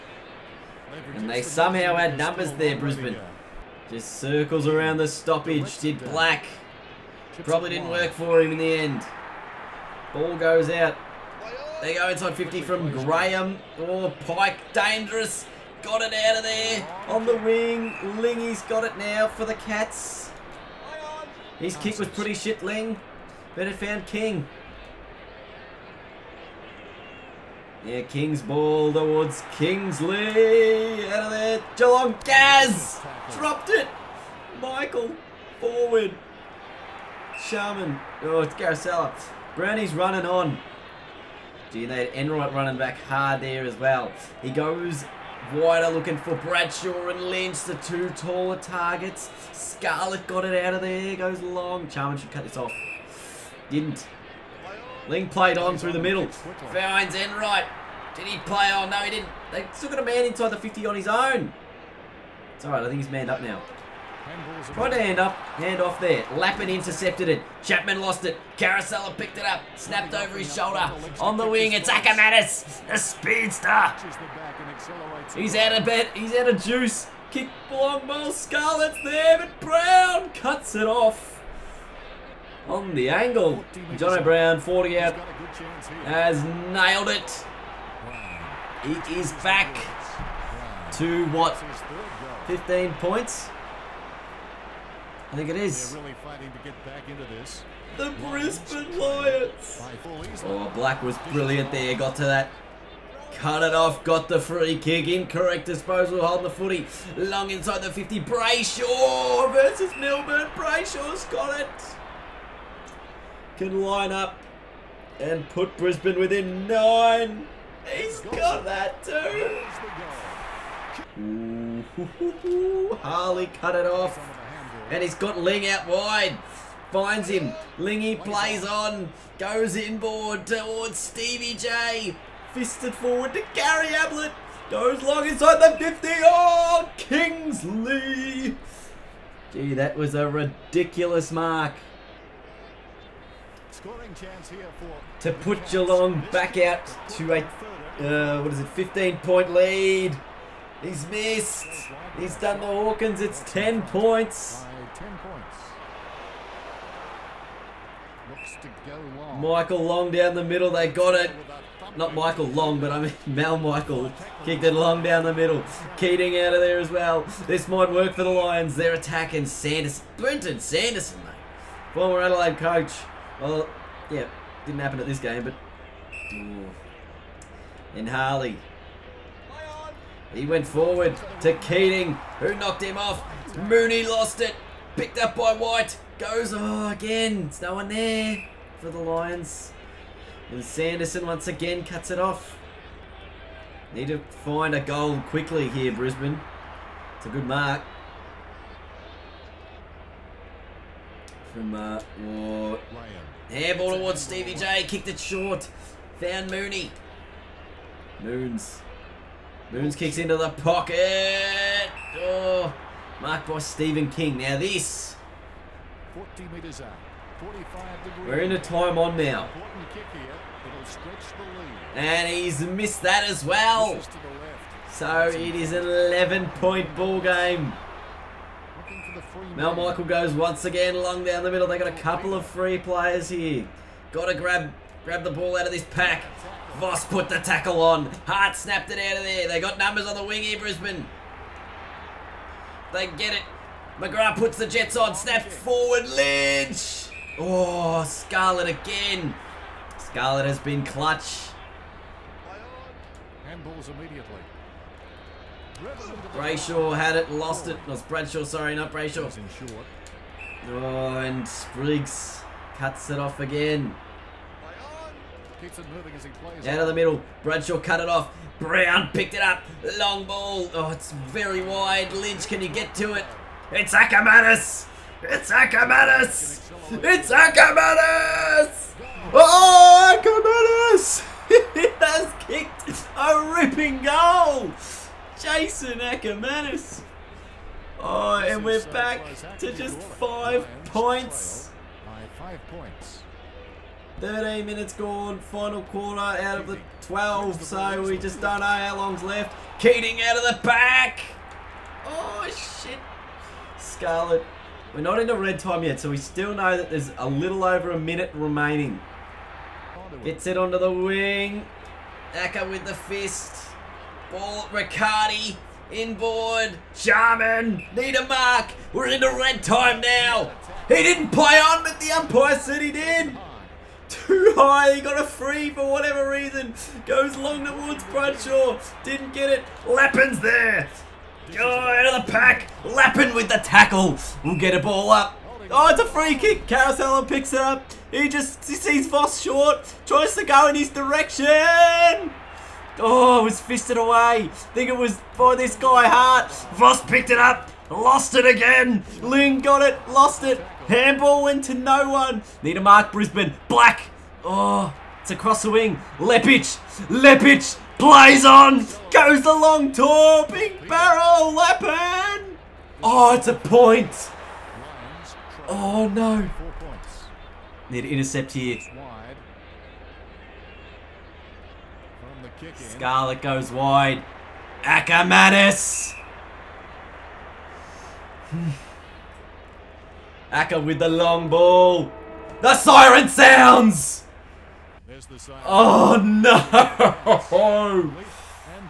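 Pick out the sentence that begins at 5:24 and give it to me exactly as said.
Too high, he got a free for whatever reason.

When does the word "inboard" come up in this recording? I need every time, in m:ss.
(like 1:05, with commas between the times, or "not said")
2:09, 5:15.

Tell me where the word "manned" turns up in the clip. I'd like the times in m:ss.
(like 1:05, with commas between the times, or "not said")
1:03.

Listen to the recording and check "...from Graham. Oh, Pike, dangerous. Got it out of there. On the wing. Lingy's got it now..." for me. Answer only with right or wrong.
right.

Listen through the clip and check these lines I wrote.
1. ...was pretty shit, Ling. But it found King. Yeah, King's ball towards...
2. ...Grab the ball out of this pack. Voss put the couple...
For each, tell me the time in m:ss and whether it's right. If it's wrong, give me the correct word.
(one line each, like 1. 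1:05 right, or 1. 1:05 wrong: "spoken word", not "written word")
1. 0:21 right
2. 3:55 wrong: "tackle", not "couple".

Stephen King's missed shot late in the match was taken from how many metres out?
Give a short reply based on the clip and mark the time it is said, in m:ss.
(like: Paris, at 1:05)
40, at 3:36.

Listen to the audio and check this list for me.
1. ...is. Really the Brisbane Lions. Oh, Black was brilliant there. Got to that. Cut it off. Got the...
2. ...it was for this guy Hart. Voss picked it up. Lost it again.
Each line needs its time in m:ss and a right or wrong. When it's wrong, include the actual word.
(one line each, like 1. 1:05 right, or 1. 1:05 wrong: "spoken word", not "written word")
1. 1:35 right
2. 5:44 right.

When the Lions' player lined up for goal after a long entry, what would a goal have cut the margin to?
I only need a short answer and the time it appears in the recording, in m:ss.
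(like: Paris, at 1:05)
9, at 1:56.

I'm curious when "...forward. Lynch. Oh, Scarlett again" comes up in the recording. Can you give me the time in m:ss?
4:05.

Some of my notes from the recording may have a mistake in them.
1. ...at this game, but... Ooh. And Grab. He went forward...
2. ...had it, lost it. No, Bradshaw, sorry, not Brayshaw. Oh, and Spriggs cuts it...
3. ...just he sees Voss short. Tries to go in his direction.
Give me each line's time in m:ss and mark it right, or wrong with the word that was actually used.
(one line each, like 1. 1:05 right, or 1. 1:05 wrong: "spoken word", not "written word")
1. 2:54 wrong: "Harley", not "Grab"
2. 4:16 right
3. 5:38 right.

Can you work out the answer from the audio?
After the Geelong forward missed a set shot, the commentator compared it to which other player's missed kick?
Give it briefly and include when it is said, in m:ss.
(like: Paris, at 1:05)
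Hawkins, at 2:32.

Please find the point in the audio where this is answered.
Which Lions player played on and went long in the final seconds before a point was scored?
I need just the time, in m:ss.
5:57.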